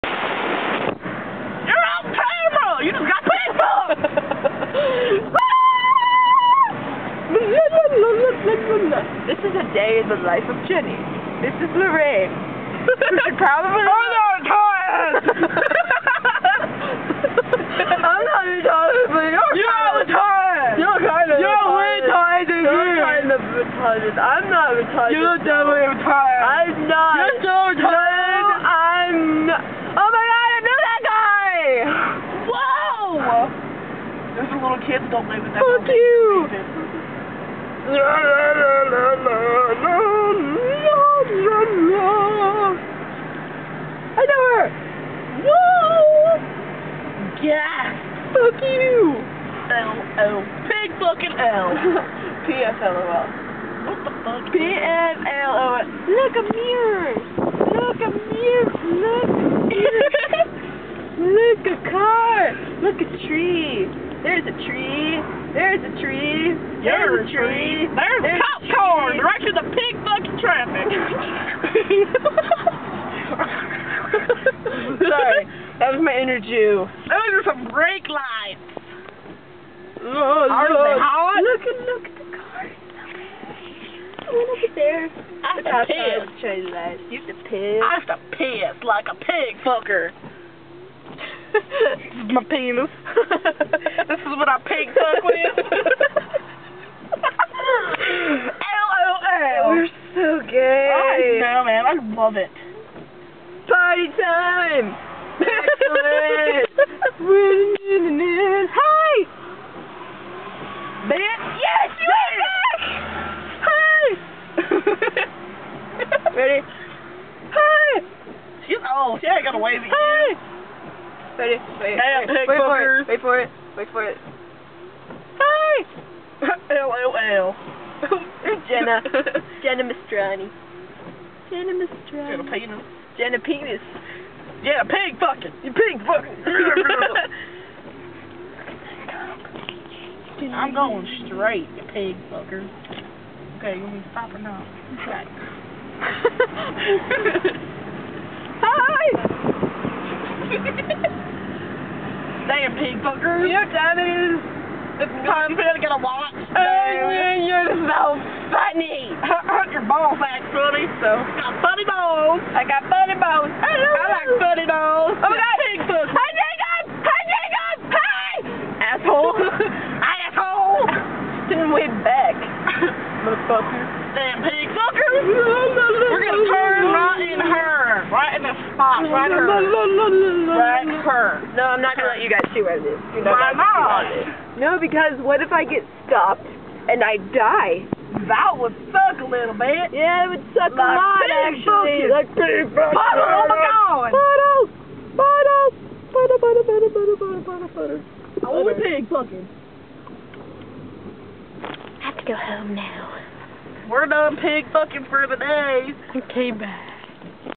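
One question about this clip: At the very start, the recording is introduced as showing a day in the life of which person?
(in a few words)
Jenny.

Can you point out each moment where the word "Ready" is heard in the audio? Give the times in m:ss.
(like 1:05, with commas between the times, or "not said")
1:56, 2:01.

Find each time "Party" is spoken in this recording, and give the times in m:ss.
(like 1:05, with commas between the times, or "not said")
1:43.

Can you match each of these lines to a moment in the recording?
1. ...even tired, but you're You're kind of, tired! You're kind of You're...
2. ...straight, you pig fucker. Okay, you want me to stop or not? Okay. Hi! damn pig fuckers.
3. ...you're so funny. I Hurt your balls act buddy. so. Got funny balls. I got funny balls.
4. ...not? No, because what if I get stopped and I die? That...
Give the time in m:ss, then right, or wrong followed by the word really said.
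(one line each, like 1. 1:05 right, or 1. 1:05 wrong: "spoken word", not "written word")
1. 0:18 right
2. 2:21 right
3. 2:37 right
4. 3:03 right.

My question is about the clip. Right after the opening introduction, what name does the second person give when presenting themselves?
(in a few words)
Lorraine.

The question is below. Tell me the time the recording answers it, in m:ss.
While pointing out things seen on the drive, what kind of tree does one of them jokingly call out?
1:08.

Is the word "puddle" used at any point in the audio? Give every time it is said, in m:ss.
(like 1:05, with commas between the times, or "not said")
3:12, 3:18.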